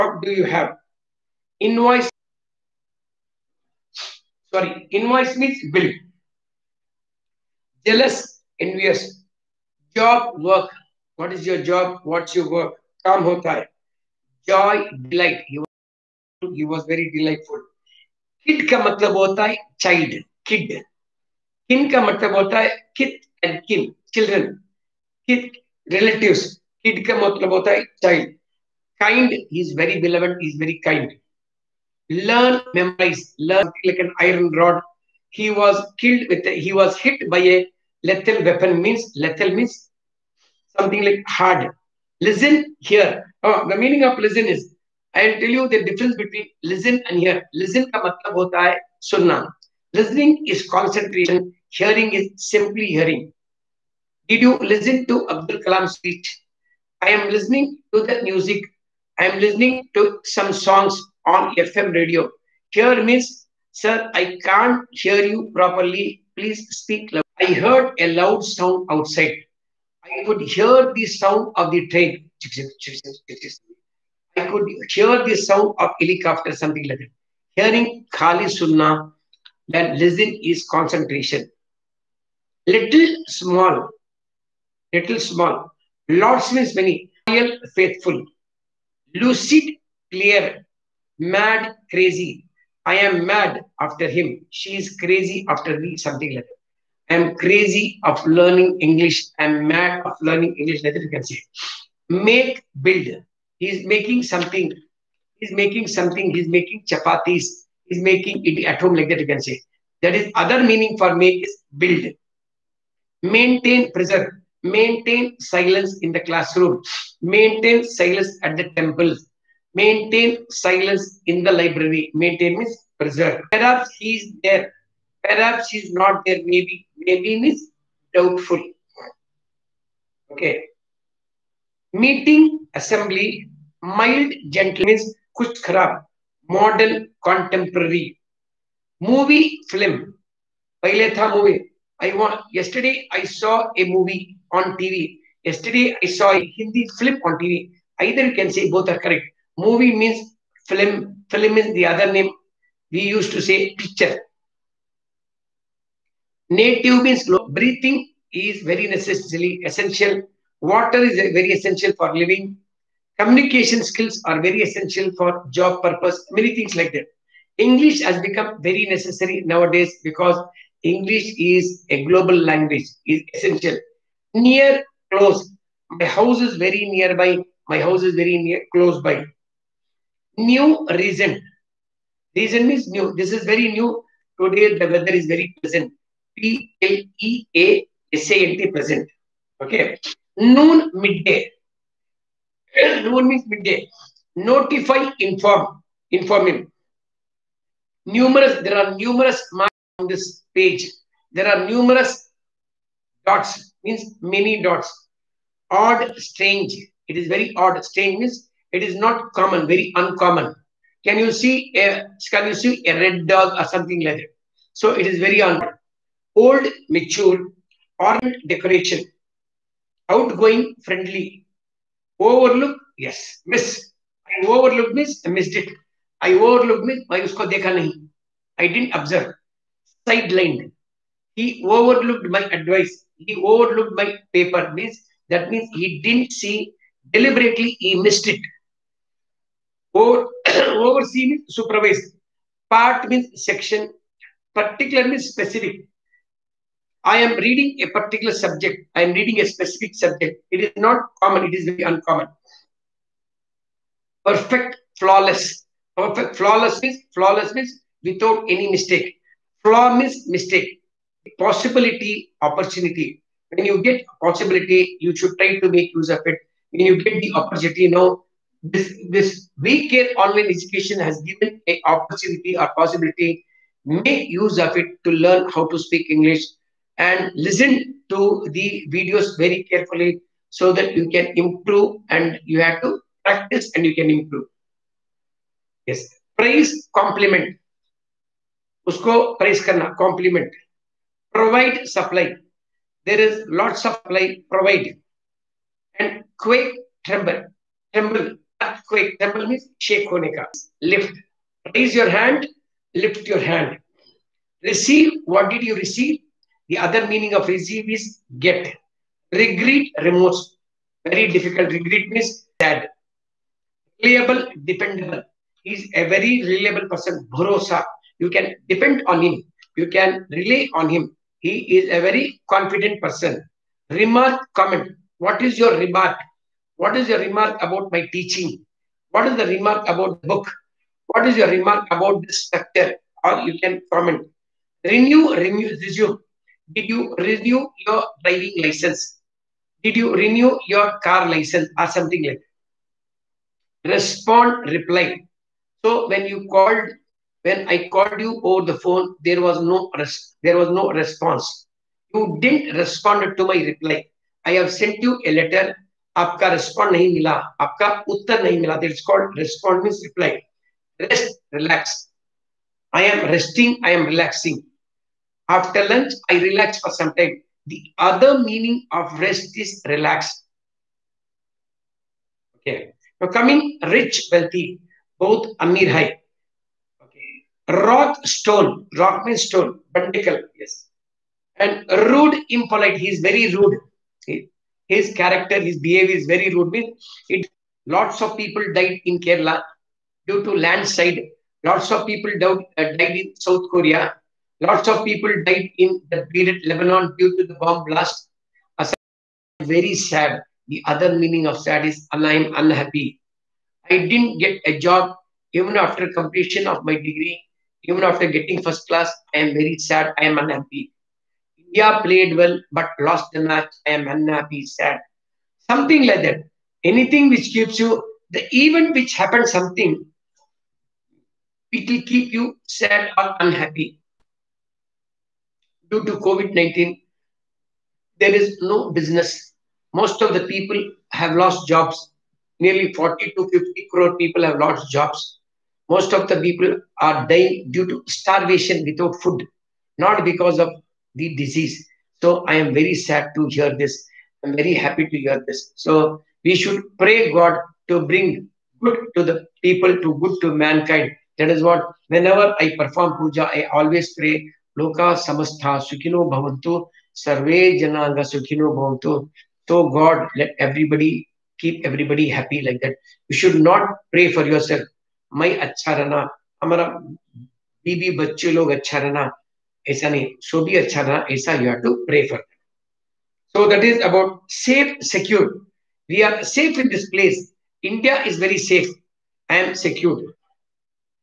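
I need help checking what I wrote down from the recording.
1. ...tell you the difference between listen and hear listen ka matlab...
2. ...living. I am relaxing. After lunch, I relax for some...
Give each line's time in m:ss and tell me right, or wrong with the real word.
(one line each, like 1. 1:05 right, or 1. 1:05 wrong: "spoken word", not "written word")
1. 0:45 right
2. 6:03 wrong: "resting", not "living".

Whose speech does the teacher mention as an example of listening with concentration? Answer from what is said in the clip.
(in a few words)
Abdul Kalam.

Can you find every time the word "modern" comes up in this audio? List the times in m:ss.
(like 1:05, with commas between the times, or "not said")
2:16.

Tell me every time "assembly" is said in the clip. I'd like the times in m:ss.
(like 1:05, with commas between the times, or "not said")
2:12.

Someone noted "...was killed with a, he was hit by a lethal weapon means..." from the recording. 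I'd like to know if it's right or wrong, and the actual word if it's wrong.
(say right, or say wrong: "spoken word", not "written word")
right.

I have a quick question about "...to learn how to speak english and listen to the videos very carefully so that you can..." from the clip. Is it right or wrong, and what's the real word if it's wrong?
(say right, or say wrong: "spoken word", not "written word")
right.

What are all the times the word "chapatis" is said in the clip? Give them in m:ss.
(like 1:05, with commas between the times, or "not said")
1:46.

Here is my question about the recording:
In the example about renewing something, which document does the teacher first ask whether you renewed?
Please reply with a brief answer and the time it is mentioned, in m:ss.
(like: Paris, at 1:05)
driving license, at 5:38.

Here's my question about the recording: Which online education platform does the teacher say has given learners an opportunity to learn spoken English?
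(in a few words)
VCare Online Education.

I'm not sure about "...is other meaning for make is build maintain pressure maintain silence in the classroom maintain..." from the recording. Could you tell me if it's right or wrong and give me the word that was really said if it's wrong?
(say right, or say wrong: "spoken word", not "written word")
right.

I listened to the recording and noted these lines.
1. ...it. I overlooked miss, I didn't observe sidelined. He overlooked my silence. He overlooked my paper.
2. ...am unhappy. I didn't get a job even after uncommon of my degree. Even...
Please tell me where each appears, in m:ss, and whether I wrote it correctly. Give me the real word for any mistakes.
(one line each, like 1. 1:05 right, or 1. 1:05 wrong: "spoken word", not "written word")
1. 3:45 wrong: "advice", not "silence"
2. 6:42 wrong: "completion", not "uncommon".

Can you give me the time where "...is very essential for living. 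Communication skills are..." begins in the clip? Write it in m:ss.
2:40.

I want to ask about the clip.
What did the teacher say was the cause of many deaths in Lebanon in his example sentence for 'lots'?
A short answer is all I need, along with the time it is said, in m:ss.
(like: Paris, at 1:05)
bomb blast, at 6:37.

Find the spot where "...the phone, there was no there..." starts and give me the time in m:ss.
5:48.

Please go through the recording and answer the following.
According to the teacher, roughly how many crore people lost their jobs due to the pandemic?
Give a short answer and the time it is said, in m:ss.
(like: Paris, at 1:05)
40 to 50 crore, at 7:12.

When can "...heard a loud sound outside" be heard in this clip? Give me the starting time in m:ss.
1:07.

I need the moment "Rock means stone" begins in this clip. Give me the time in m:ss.
6:18.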